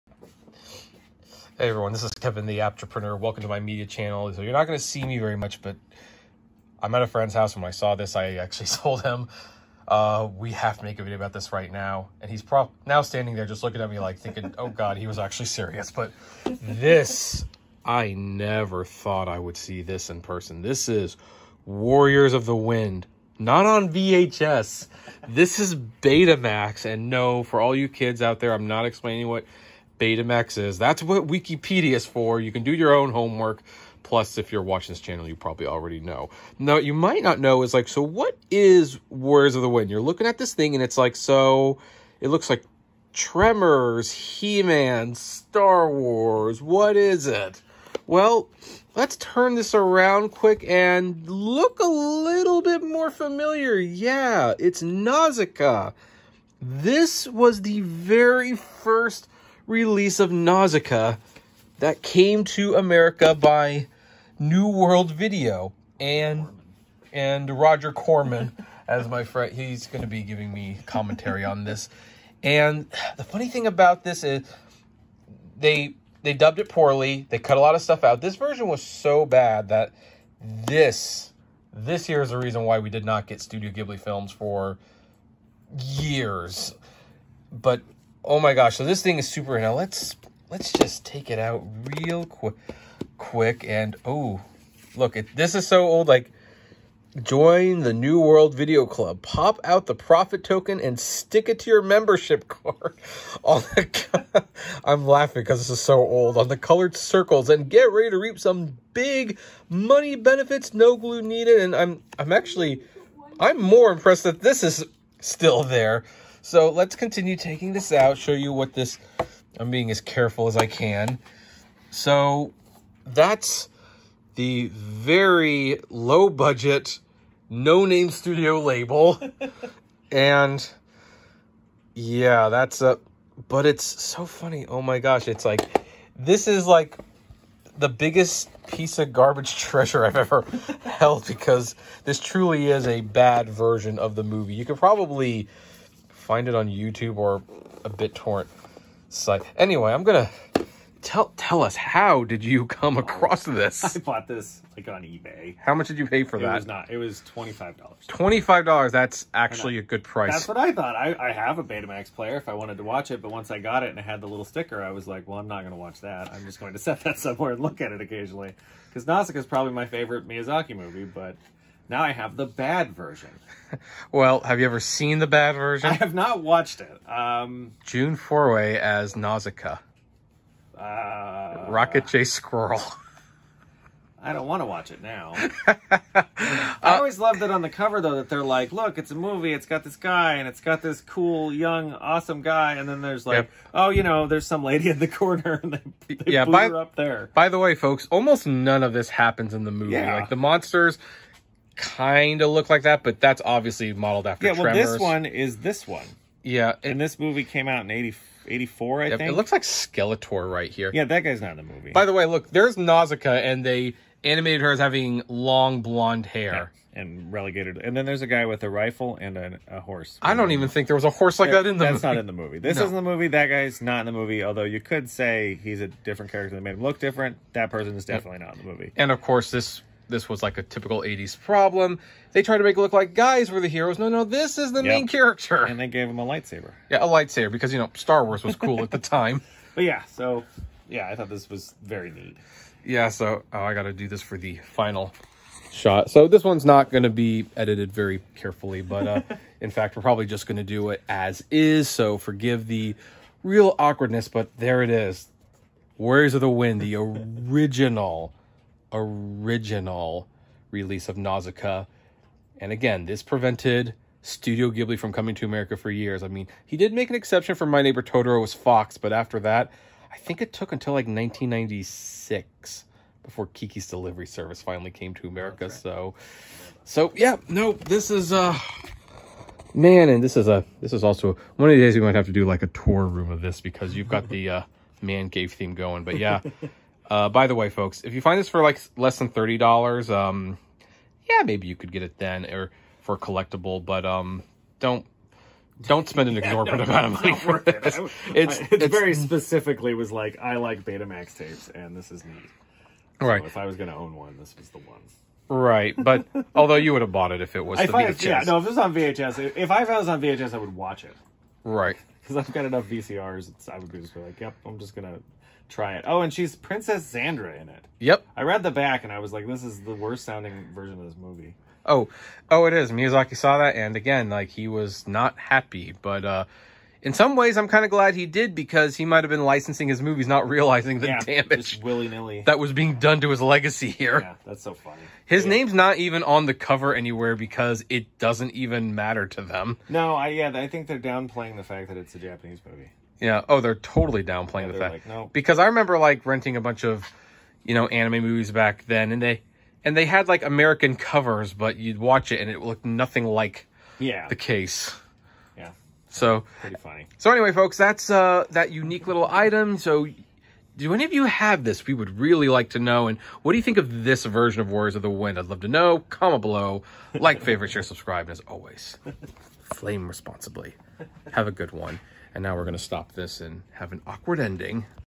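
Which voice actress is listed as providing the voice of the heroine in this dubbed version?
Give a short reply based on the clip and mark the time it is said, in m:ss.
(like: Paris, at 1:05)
June Foray, at 2:57.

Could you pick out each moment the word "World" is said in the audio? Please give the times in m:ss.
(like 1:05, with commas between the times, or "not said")
1:04, 1:38.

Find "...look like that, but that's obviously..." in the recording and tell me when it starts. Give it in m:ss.
3:22.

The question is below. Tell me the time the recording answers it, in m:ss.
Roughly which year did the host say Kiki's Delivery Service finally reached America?
4:31.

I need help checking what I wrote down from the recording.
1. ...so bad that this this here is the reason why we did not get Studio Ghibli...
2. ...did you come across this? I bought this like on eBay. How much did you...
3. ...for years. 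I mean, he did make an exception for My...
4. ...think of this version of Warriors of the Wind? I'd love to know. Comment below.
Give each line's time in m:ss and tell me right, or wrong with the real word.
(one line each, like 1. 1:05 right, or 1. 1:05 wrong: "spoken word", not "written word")
1. 1:18 right
2. 2:32 right
3. 4:25 right
4. 6:03 right.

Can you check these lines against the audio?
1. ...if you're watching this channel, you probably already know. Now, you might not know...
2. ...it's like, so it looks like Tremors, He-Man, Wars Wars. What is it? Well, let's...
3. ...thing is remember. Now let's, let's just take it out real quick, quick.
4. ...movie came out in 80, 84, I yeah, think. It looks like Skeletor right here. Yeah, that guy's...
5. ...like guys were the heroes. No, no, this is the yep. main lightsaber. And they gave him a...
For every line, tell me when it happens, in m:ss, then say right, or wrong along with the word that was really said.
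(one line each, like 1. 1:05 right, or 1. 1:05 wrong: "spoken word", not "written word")
1. 0:34 right
2. 0:40 wrong: "Star", not "Wars"
3. 1:29 wrong: "super", not "remember"
4. 3:27 right
5. 3:52 wrong: "character", not "lightsaber".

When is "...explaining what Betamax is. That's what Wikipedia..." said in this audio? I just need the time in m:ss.
0:28.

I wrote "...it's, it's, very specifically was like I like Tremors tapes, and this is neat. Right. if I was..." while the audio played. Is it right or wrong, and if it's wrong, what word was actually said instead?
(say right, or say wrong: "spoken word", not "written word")
wrong: "Betamax", not "Tremors".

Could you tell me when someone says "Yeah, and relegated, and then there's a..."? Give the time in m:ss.
3:36.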